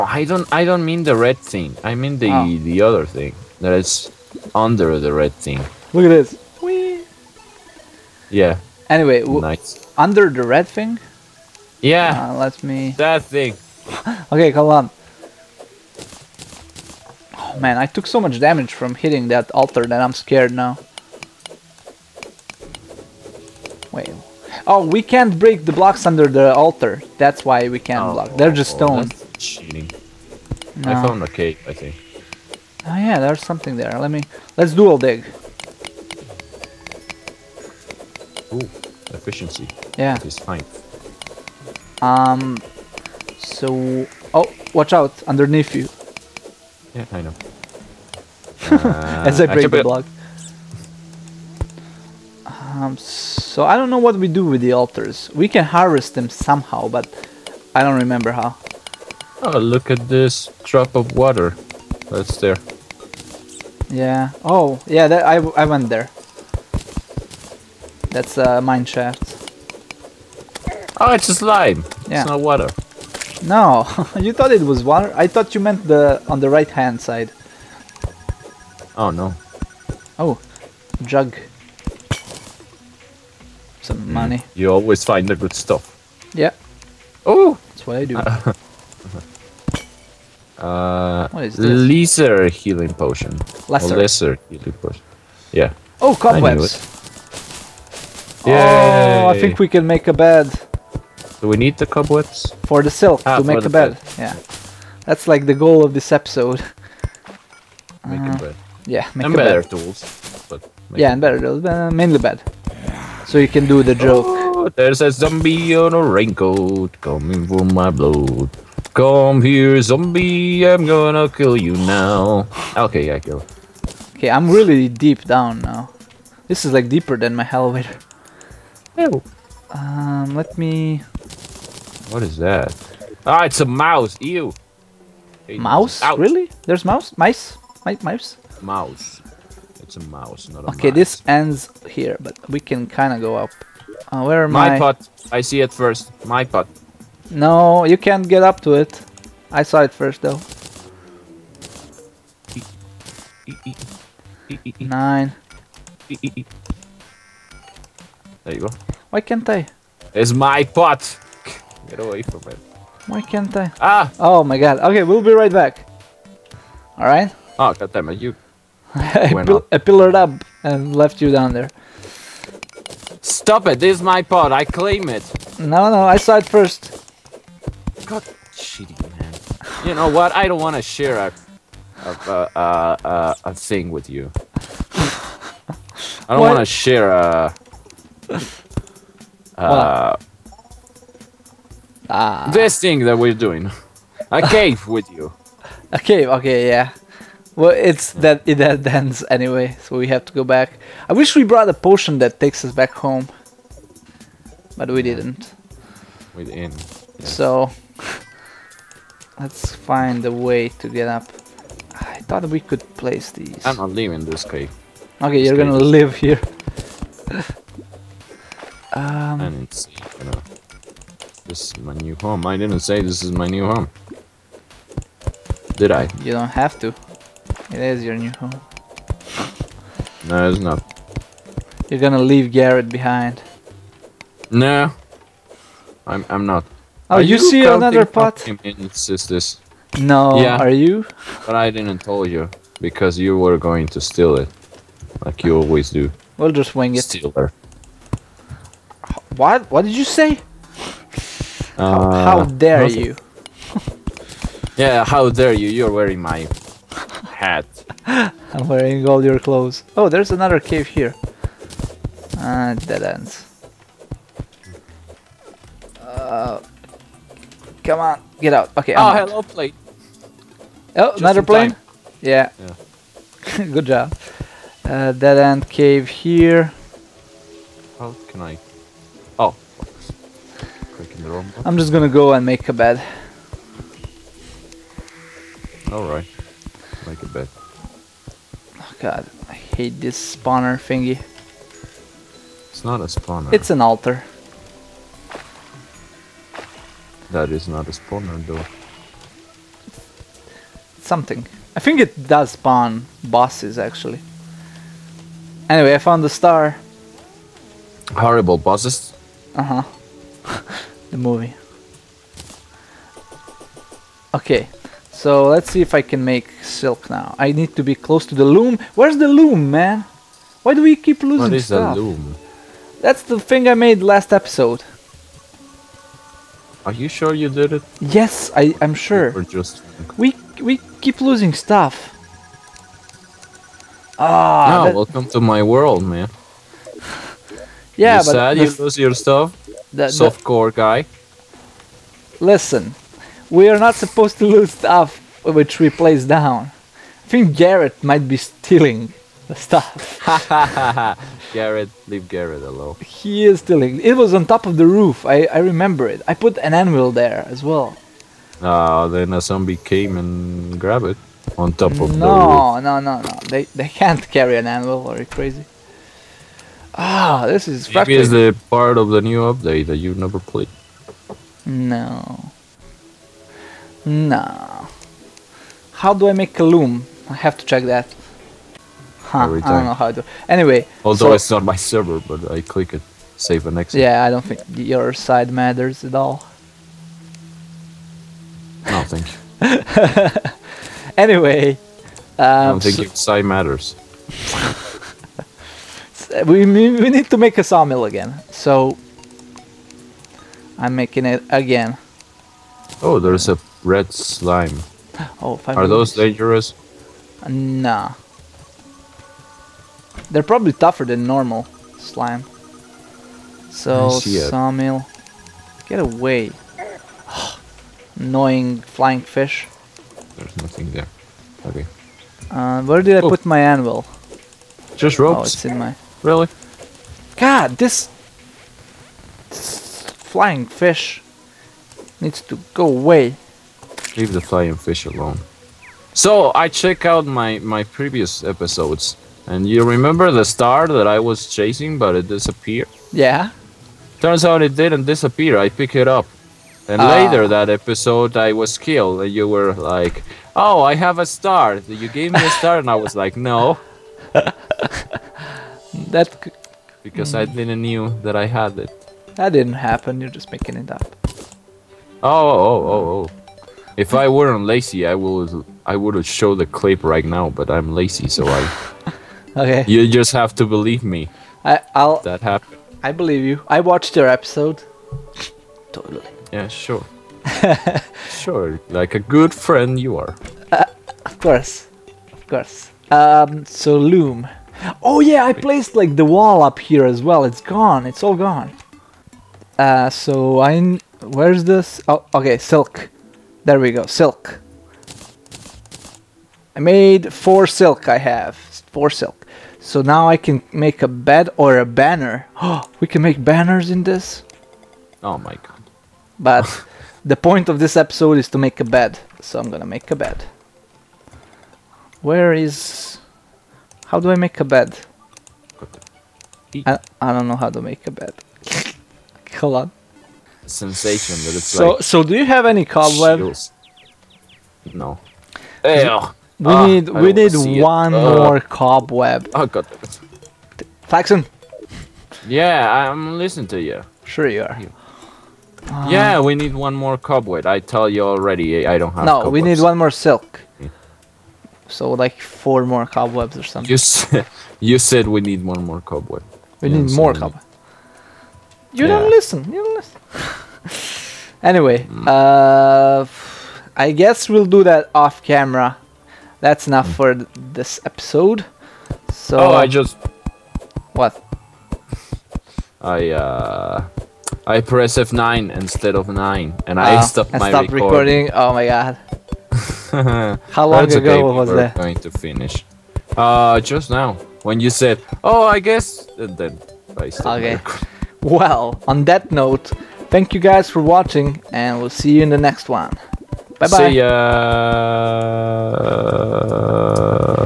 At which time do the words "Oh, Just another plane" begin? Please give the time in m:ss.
4:30.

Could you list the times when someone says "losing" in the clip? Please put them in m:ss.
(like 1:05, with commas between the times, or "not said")
5:21, 5:31.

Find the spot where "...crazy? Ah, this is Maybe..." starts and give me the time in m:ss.
6:05.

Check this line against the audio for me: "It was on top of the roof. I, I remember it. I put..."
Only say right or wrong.
right.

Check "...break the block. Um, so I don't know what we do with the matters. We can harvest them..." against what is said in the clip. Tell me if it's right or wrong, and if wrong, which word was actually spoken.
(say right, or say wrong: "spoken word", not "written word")
wrong: "altars", not "matters".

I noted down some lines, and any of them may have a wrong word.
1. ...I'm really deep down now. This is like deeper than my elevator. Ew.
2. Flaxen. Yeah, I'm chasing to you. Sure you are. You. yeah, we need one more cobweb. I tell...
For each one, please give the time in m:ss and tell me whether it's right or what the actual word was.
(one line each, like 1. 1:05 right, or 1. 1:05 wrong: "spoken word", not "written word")
1. 2:04 right
2. 8:51 wrong: "listening", not "chasing".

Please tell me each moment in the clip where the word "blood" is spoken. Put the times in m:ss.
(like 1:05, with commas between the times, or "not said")
1:57.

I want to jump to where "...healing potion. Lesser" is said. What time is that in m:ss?
1:32.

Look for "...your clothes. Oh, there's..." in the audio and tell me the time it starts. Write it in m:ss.
4:19.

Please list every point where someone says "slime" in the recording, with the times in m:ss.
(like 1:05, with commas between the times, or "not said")
1:11, 6:44, 6:51.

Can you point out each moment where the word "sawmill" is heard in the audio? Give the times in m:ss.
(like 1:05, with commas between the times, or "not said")
6:37, 6:54.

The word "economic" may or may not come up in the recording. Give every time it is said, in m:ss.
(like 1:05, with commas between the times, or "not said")
not said.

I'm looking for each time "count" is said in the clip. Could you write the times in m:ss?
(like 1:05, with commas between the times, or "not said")
not said.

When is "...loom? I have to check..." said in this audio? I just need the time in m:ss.
6:16.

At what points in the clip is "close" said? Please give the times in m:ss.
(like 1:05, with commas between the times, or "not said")
5:17.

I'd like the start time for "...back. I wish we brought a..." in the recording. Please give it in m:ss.
3:20.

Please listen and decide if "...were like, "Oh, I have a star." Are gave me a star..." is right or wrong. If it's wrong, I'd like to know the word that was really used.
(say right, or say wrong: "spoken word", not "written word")
wrong: "You", not "Are".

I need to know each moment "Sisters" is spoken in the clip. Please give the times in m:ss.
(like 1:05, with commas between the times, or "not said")
3:58.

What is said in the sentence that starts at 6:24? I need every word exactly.
Yeah, I don't think your side matters at all.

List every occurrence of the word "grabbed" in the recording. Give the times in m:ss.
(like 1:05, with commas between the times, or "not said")
6:00.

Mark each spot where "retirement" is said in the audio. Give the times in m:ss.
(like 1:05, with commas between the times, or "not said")
not said.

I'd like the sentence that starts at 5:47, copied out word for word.
I think Garrett might be stealing the stuff.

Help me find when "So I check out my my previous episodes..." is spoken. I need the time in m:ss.
7:16.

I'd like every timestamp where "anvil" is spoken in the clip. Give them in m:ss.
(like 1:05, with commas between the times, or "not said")
5:56, 6:04, 7:03.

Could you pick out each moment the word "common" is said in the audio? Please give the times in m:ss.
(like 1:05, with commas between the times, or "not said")
not said.